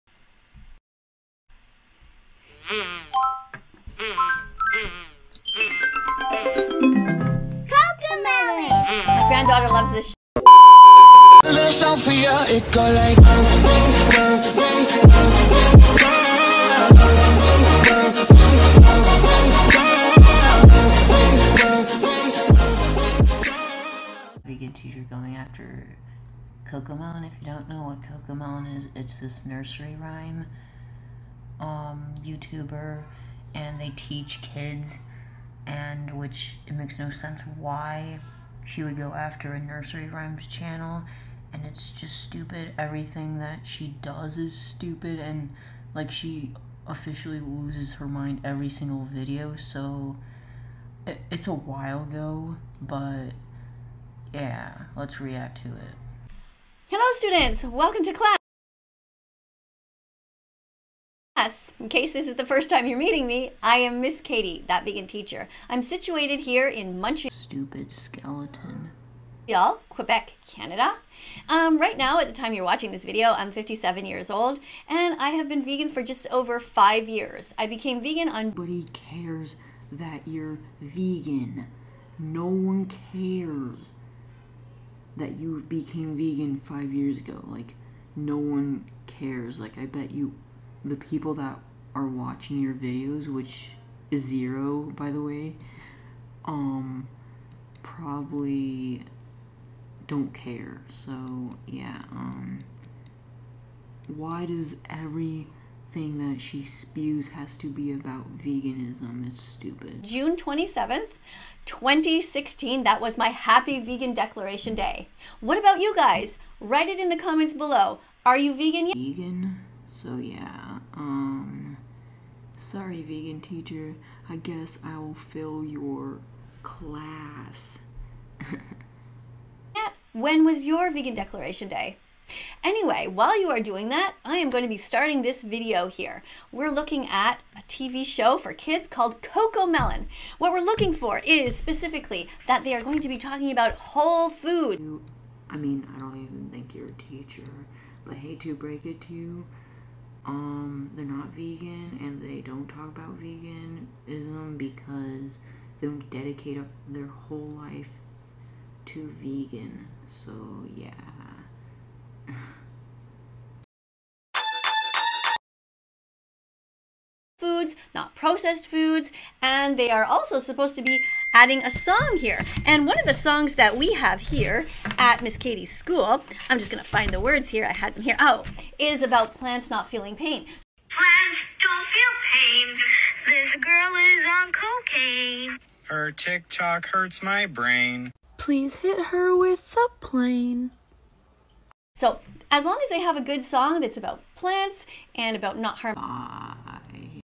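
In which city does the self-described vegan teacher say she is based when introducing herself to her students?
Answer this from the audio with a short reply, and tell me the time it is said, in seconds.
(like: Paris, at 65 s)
Montreal, at 67 s.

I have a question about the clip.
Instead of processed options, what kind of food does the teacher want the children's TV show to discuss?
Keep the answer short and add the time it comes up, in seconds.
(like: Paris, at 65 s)
whole food, at 143 s.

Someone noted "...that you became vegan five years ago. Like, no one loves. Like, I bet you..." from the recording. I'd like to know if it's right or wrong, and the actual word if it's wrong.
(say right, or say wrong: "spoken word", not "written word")
wrong: "cares", not "loves".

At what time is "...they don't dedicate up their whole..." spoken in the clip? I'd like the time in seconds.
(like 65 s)
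155 s.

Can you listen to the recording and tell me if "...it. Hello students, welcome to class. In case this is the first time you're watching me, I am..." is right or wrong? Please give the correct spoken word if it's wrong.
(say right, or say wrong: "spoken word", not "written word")
wrong: "meeting", not "watching".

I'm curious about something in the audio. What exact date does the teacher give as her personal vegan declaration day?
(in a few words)
June 27, 2016.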